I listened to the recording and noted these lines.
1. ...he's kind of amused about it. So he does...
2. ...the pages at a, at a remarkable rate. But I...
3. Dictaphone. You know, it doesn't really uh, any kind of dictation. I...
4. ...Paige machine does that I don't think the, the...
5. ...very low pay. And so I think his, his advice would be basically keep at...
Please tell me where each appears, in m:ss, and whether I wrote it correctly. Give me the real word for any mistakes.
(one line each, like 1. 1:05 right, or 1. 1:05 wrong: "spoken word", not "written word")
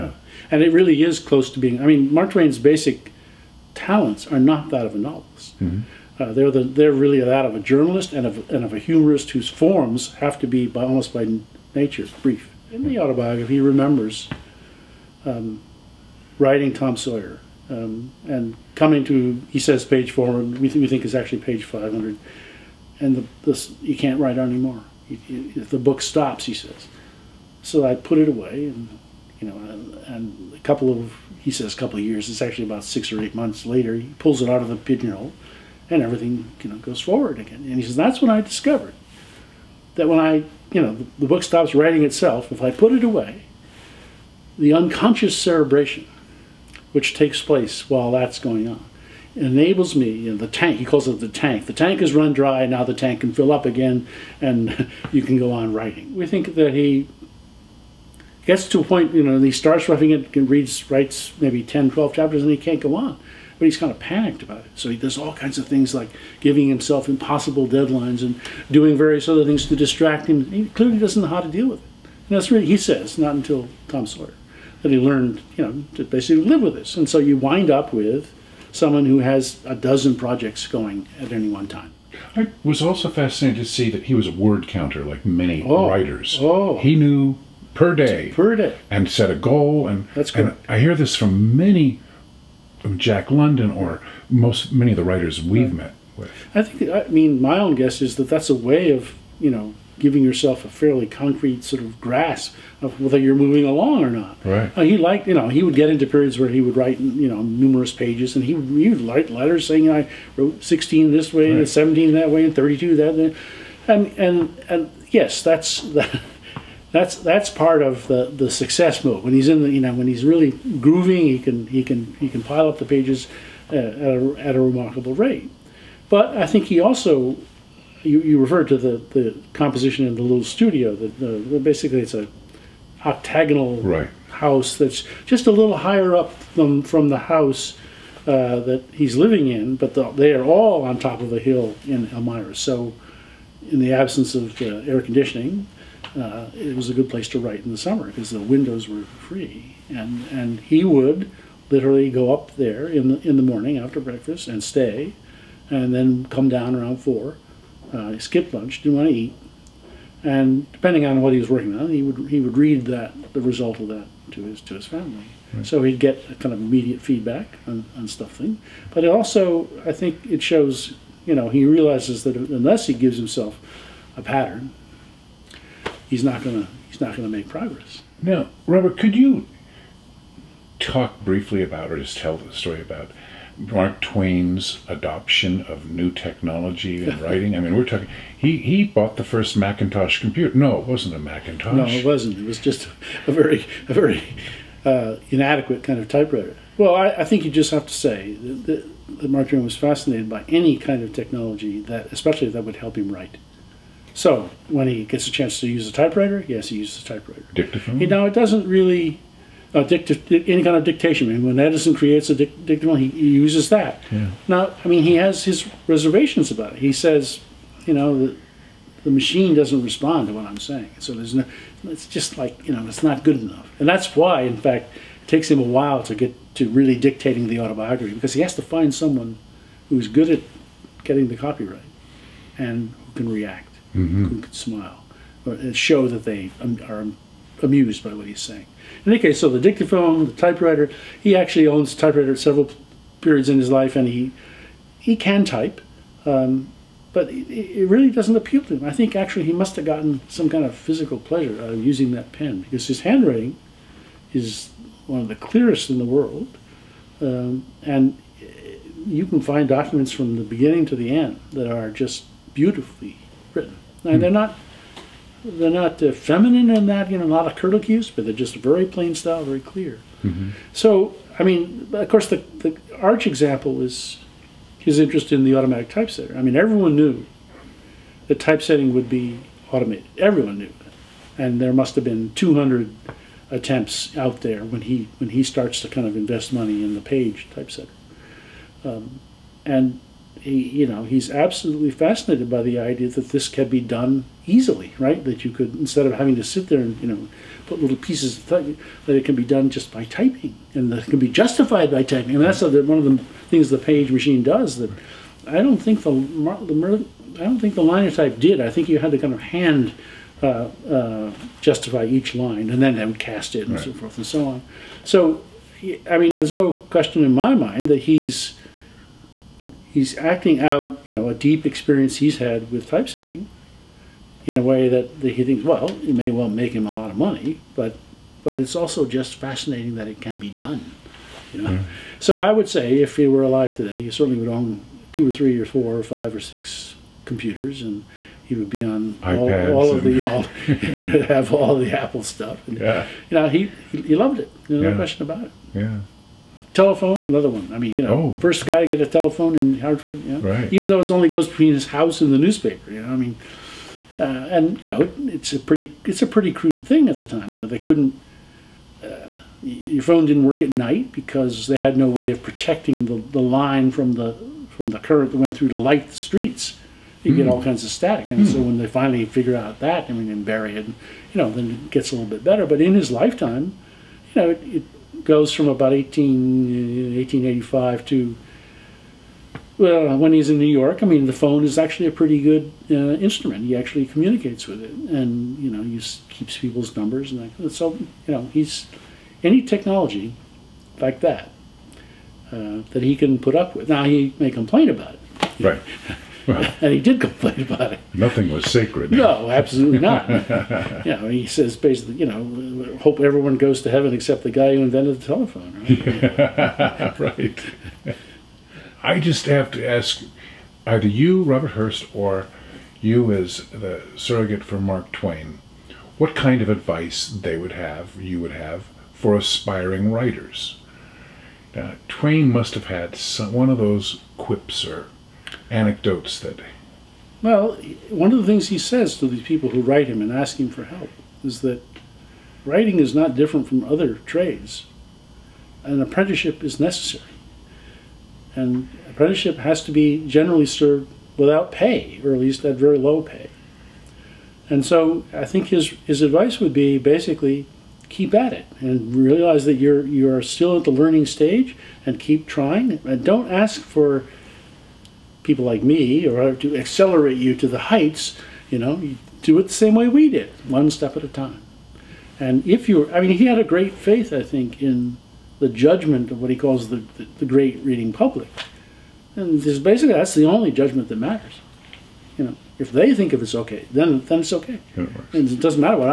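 1. 1:03 wrong: "panicked", not "amused"
2. 2:02 right
3. 3:27 right
4. 5:03 right
5. 7:22 right.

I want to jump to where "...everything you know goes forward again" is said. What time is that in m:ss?
0:36.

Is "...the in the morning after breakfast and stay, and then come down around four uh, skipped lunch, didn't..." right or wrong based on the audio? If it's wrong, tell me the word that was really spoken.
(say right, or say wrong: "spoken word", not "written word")
right.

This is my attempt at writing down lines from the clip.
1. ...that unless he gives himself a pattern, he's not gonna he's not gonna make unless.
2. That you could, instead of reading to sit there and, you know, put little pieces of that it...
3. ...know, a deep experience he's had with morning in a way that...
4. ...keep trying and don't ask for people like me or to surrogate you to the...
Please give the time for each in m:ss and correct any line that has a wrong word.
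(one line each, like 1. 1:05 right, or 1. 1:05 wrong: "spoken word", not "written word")
1. 2:52 wrong: "progress", not "unless"
2. 4:55 wrong: "having", not "reading"
3. 5:21 wrong: "typesetting", not "morning"
4. 7:32 wrong: "accelerate", not "surrogate".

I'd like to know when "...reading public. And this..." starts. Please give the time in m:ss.
7:47.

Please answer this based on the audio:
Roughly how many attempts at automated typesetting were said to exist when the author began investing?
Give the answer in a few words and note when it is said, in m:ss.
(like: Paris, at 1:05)
200, at 4:42.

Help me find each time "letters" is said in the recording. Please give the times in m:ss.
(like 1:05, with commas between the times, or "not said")
1:49.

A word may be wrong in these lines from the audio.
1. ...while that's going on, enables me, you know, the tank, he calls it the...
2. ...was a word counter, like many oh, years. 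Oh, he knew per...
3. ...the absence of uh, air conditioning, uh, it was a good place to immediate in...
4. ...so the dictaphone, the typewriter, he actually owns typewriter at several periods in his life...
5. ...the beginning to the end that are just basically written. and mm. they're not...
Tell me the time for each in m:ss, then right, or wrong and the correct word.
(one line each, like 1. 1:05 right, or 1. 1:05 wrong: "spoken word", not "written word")
1. 0:47 right
2. 1:24 wrong: "writers", not "years"
3. 2:23 wrong: "write", not "immediate"
4. 3:59 right
5. 4:20 wrong: "beautifully", not "basically".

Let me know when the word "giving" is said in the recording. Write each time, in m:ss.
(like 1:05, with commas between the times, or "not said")
1:06, 1:40.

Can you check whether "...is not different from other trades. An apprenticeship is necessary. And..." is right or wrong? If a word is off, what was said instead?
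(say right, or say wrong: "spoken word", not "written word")
right.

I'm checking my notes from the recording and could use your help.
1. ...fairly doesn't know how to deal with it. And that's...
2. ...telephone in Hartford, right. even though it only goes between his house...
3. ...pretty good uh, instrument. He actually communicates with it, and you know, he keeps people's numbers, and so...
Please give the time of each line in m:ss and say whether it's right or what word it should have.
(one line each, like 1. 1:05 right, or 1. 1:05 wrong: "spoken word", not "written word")
1. 1:10 wrong: "clearly", not "fairly"
2. 5:49 right
3. 6:22 right.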